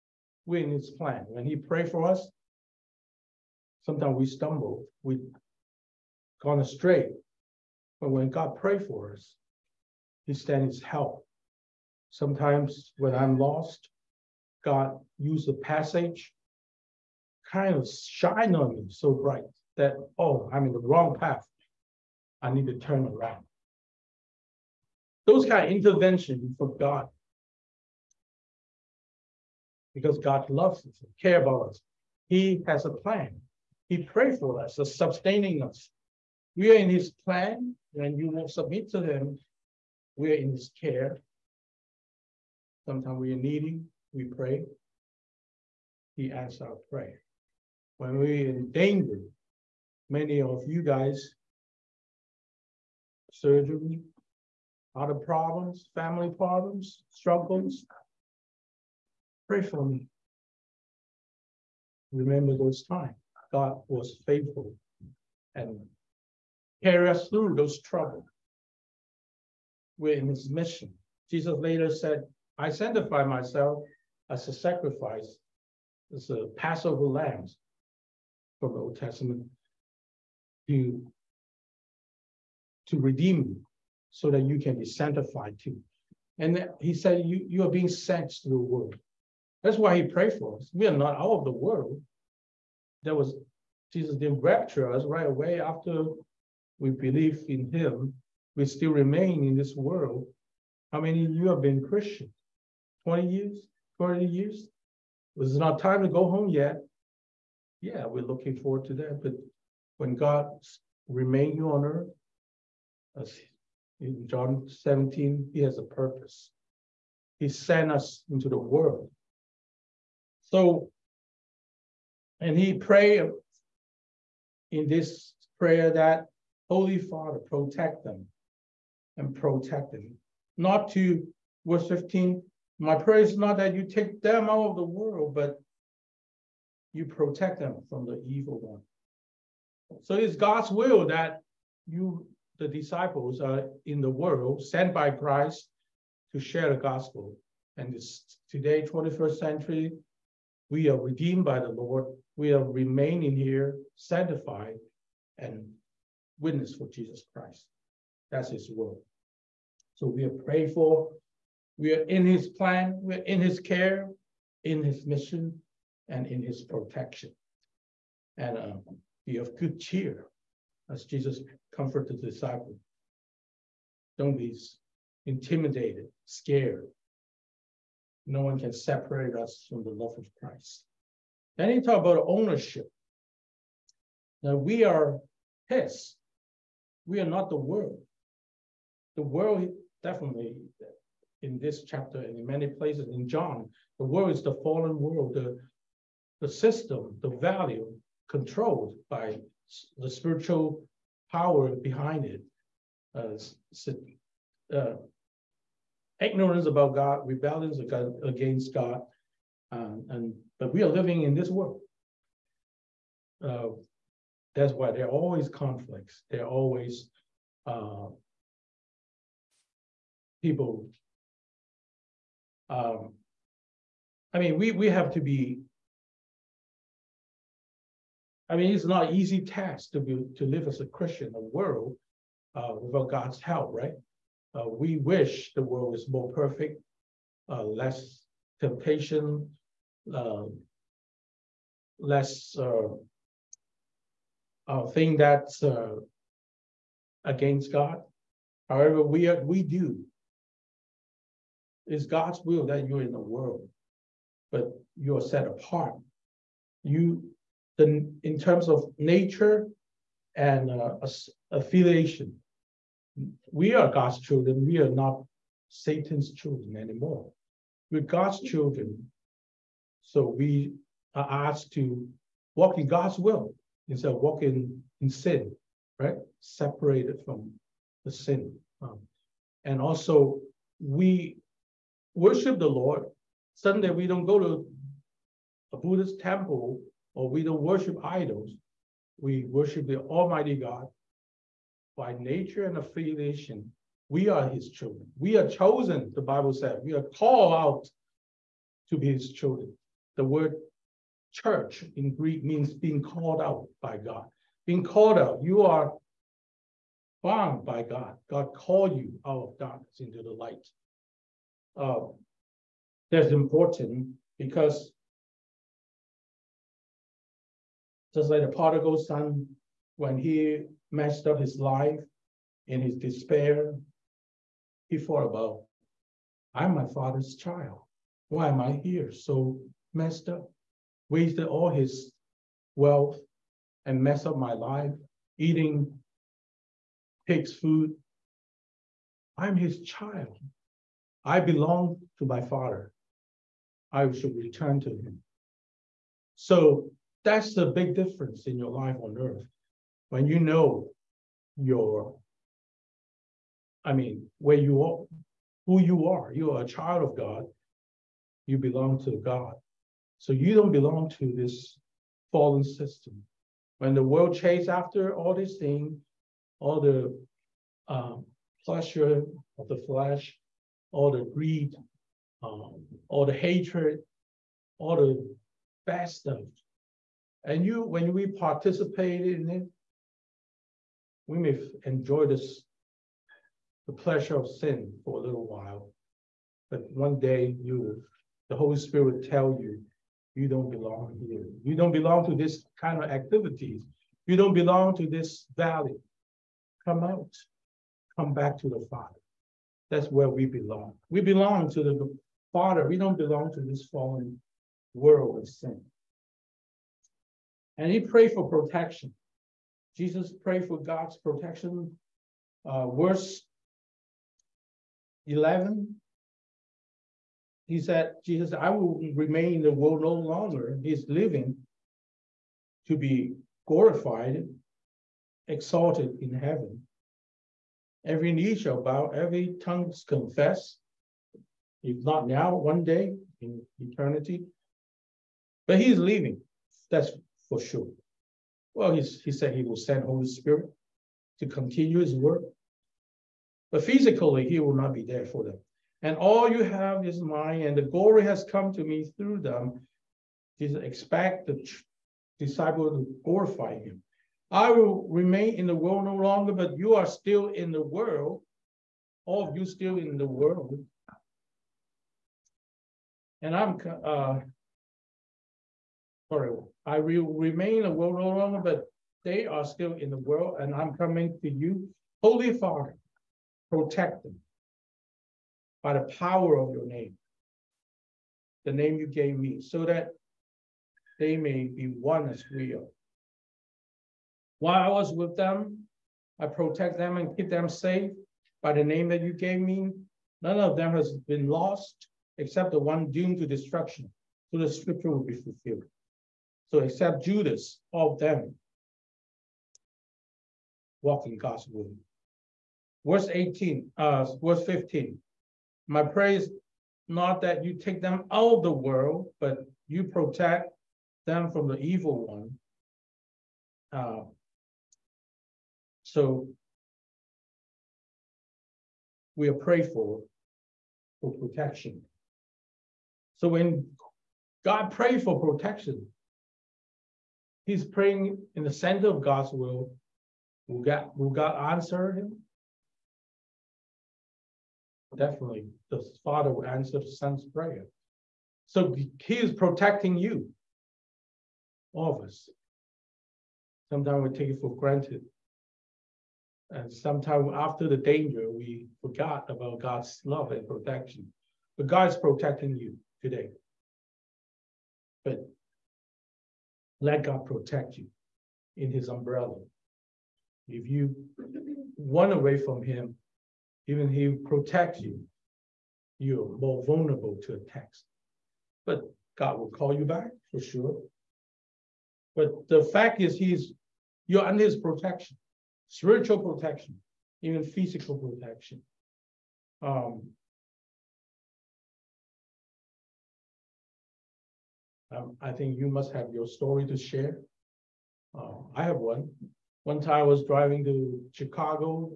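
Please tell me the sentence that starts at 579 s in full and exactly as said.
Um, Um, I think you must have your story to share.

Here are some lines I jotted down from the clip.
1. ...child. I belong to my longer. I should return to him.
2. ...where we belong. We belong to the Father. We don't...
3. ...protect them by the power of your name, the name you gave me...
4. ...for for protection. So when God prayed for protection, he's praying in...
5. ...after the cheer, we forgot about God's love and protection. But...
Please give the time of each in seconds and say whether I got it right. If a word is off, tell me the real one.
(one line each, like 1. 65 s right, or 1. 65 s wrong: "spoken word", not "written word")
1. 339 s wrong: "father", not "longer"
2. 400 s right
3. 473 s right
4. 519 s right
5. 547 s wrong: "danger", not "cheer".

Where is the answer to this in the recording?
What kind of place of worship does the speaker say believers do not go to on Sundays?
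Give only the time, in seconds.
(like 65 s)
285 s.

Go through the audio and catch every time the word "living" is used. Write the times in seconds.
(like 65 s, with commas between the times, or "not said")
210 s, 421 s.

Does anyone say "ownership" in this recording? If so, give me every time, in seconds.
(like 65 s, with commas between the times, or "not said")
182 s.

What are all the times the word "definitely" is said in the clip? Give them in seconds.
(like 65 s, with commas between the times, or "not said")
190 s, 535 s.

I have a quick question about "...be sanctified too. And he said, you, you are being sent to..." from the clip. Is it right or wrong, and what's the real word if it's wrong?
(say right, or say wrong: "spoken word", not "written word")
right.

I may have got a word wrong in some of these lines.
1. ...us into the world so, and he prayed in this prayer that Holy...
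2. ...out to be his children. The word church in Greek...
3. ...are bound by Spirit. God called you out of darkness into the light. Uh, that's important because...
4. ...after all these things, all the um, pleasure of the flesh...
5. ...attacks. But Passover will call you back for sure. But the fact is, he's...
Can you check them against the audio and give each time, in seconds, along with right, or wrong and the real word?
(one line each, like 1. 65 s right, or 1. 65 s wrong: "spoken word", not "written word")
1. 117 s right
2. 297 s right
3. 305 s wrong: "God", not "Spirit"
4. 364 s right
5. 567 s wrong: "God", not "Passover".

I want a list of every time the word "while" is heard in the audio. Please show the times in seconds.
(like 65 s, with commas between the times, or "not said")
385 s, 484 s.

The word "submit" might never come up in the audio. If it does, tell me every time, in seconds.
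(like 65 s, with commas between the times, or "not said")
38 s.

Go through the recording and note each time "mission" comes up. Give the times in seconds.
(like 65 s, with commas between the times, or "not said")
70 s, 165 s.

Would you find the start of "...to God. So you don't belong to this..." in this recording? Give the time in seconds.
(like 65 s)
359 s.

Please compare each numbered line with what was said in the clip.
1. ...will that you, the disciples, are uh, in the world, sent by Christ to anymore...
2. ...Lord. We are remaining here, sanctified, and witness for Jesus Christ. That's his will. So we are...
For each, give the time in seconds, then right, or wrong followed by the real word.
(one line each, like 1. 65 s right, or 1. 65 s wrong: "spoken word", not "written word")
1. 140 s wrong: "share", not "anymore"
2. 151 s right.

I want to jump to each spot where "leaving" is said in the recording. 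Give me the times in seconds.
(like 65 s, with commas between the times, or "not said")
435 s.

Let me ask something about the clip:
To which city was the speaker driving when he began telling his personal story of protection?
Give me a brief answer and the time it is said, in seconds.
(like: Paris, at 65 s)
Chicago, at 591 s.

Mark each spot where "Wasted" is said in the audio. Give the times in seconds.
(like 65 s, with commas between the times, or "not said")
331 s.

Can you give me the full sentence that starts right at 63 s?
God was faithful and carry us through those troubles.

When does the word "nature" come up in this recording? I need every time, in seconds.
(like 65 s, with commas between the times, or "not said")
258 s, 292 s.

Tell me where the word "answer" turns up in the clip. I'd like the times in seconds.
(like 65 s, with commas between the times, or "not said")
46 s, 531 s, 536 s.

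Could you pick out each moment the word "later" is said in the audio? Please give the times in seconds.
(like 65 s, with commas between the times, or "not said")
71 s.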